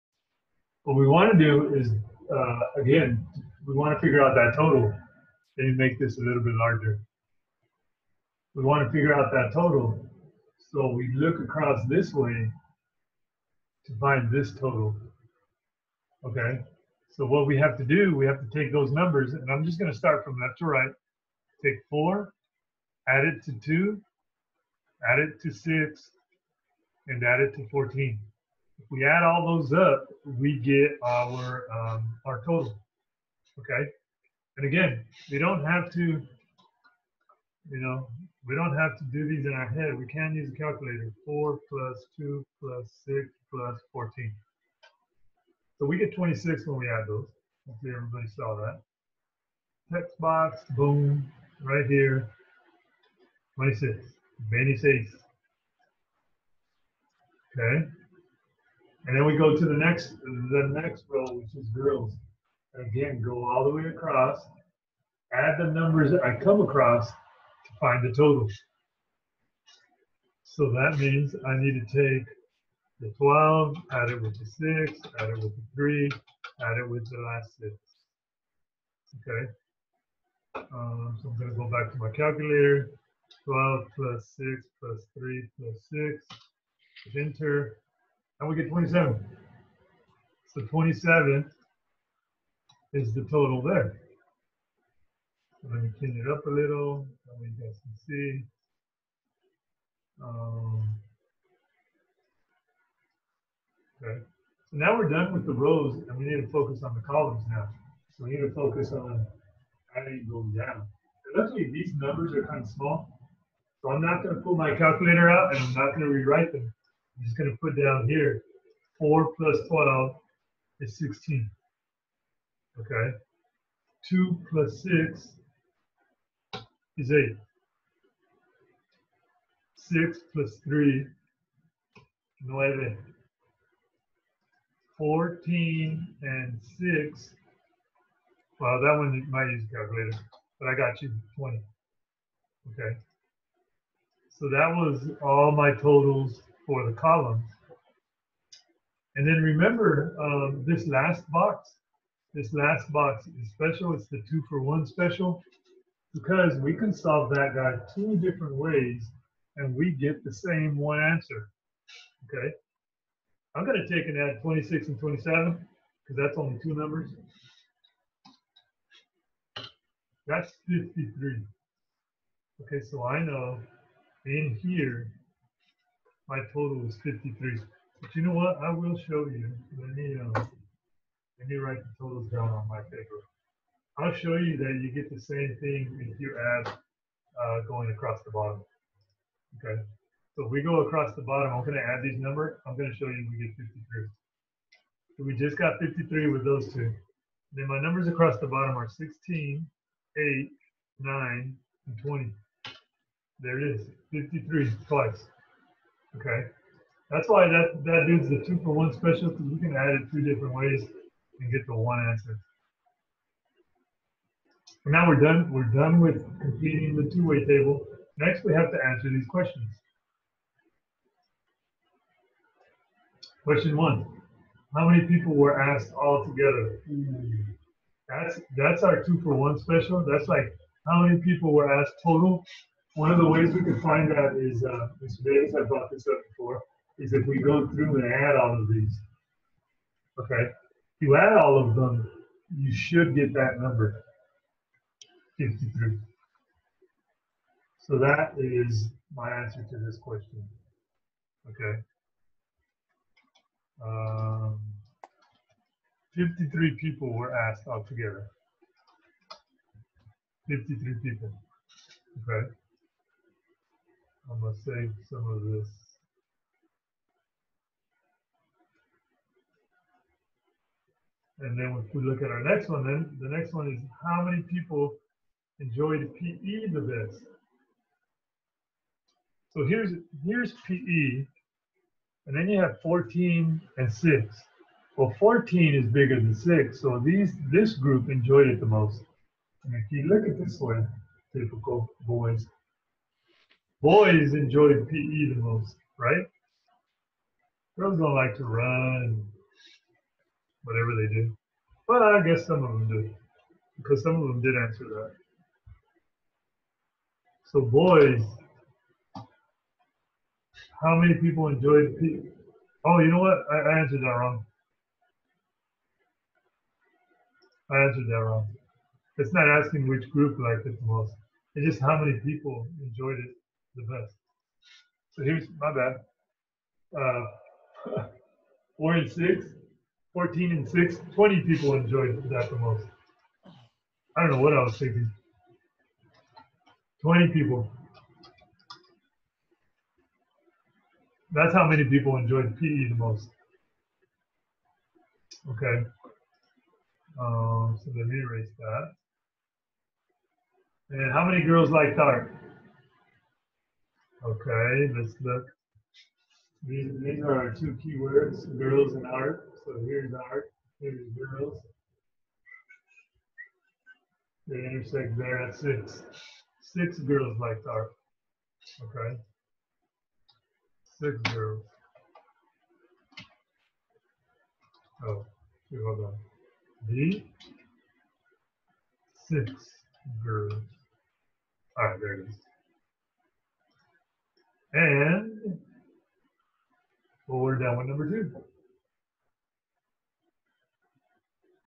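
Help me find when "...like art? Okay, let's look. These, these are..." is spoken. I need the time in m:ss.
5:51.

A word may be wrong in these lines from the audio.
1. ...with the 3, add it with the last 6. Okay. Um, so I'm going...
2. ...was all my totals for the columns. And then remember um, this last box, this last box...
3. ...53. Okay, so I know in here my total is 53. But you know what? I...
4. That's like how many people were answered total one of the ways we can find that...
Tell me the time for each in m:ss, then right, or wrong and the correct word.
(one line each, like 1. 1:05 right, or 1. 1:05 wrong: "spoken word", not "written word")
1. 1:15 right
2. 2:24 right
3. 2:50 right
4. 3:50 wrong: "asked", not "answered".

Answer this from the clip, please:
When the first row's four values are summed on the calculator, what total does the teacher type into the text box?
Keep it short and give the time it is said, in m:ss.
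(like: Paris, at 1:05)
26, at 0:45.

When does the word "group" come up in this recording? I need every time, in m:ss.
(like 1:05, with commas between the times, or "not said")
4:47, 5:20.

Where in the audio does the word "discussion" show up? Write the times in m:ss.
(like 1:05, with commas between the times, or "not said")
not said.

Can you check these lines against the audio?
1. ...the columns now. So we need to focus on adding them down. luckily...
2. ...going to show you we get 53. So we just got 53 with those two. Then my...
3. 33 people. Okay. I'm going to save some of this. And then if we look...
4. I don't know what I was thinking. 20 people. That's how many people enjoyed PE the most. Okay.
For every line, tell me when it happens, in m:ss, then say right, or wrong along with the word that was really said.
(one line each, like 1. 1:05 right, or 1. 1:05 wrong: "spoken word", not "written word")
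1. 1:46 right
2. 3:12 right
3. 4:20 wrong: "53", not "33"
4. 5:34 right.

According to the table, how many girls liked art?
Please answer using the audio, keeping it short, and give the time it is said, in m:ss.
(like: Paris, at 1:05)
6, at 6:06.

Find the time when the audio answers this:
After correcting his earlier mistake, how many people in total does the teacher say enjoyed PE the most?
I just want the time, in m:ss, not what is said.
5:31.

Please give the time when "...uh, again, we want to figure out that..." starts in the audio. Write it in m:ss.
0:02.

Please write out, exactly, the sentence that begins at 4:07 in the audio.
So that is my answer to this question.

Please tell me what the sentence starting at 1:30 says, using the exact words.
So 27 is the total there.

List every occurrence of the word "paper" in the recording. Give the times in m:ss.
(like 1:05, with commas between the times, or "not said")
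3:02.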